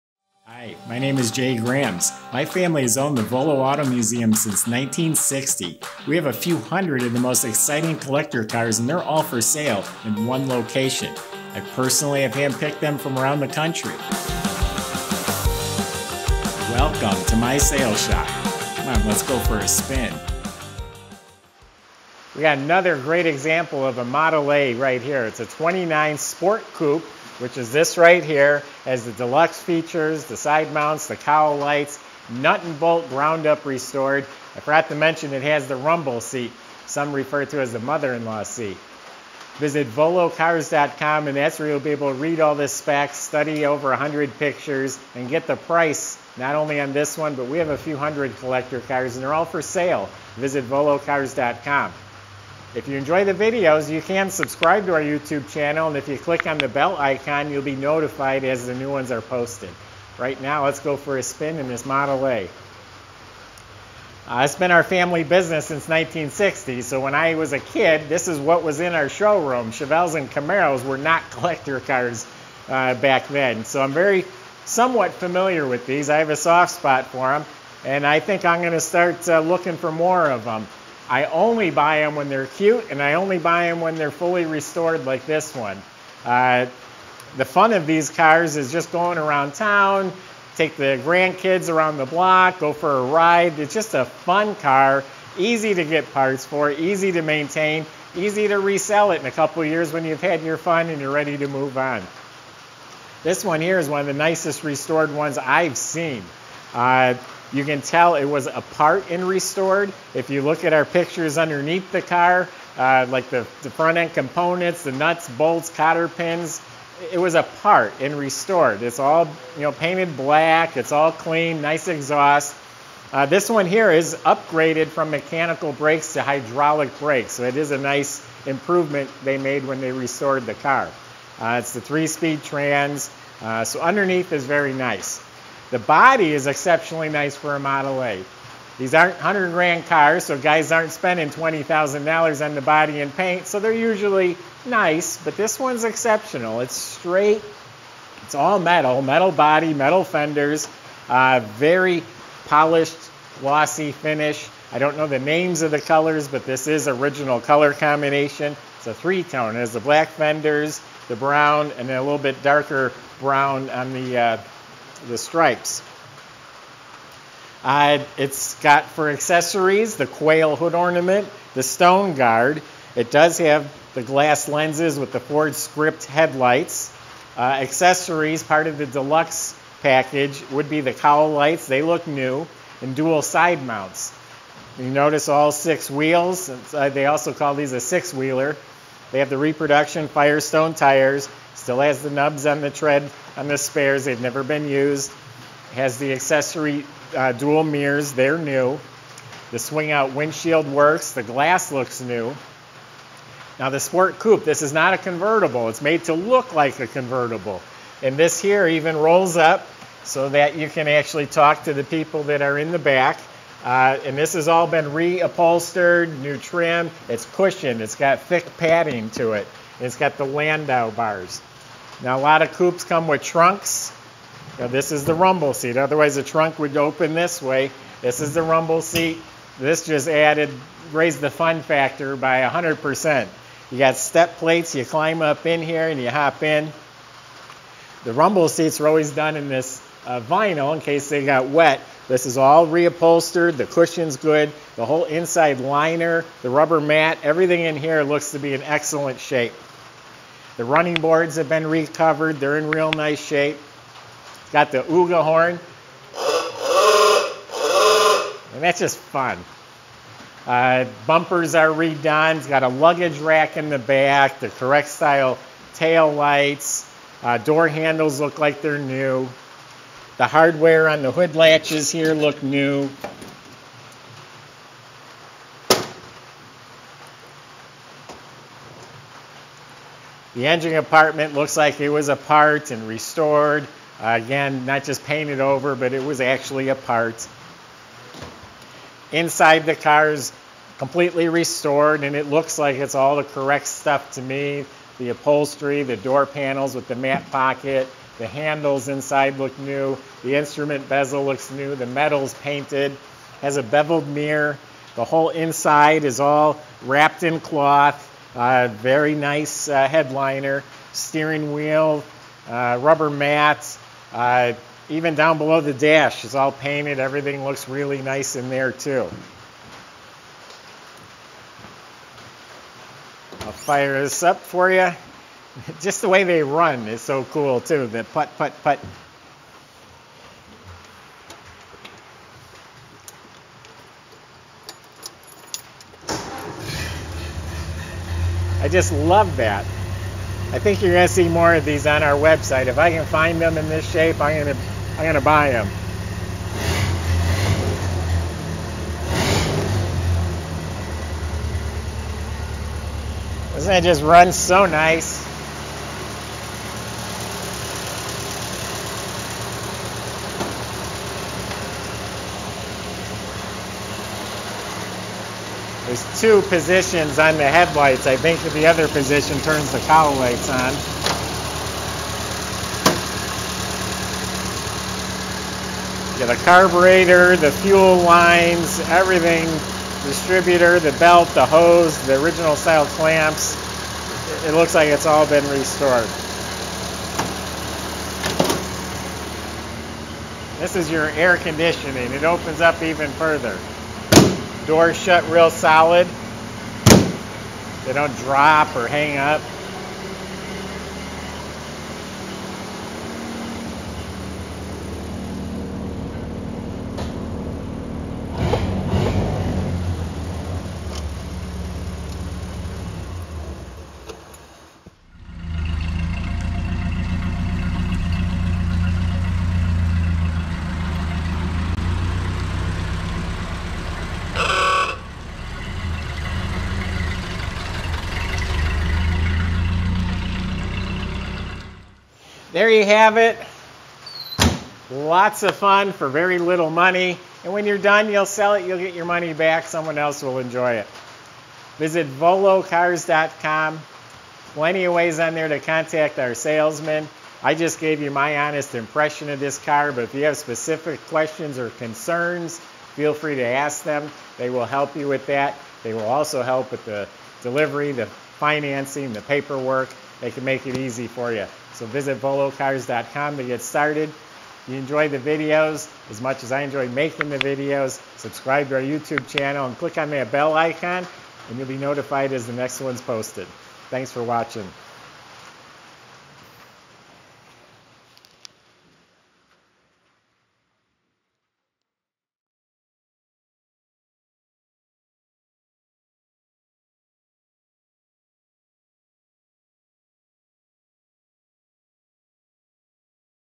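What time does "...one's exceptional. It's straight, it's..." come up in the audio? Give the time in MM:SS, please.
02:25.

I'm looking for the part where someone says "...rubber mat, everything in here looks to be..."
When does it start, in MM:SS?
04:06.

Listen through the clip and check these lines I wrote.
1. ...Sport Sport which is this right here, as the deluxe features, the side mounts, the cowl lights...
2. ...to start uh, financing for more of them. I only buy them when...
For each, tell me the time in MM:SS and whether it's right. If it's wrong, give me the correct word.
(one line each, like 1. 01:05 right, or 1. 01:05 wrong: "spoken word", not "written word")
1. 00:26 wrong: "Coupe", not "Sport"
2. 01:18 wrong: "looking", not "financing".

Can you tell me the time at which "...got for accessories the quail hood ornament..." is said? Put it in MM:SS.
02:48.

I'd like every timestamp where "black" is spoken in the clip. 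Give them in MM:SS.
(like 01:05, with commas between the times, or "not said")
02:00, 02:39.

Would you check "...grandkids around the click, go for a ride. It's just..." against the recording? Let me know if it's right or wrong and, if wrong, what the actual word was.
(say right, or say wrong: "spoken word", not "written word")
wrong: "block", not "click".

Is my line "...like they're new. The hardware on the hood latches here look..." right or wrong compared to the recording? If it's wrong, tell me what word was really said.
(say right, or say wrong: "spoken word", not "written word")
right.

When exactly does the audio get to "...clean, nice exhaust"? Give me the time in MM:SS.
02:01.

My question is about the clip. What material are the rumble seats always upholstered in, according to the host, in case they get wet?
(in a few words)
vinyl.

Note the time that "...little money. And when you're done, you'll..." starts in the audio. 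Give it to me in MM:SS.
07:16.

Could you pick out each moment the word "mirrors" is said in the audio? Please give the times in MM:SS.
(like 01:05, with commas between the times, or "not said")
03:17, 05:04.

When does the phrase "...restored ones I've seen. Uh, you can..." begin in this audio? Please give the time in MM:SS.
01:44.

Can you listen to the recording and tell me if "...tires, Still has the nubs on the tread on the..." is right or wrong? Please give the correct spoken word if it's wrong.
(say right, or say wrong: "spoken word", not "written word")
right.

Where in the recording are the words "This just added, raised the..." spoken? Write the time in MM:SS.
03:49.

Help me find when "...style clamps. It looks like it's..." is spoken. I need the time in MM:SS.
06:22.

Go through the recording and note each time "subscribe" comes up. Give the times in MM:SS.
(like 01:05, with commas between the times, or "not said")
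00:54, 07:48.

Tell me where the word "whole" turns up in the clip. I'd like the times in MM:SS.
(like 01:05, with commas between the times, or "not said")
04:04, 05:05.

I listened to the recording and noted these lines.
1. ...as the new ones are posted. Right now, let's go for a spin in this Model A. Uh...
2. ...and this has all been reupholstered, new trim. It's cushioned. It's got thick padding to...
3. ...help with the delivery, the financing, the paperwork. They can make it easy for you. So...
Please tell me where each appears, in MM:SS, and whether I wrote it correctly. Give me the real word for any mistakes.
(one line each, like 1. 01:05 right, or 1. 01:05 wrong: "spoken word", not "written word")
1. 00:58 right
2. 03:34 right
3. 07:36 right.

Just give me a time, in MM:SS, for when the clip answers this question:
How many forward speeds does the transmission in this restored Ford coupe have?
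02:11.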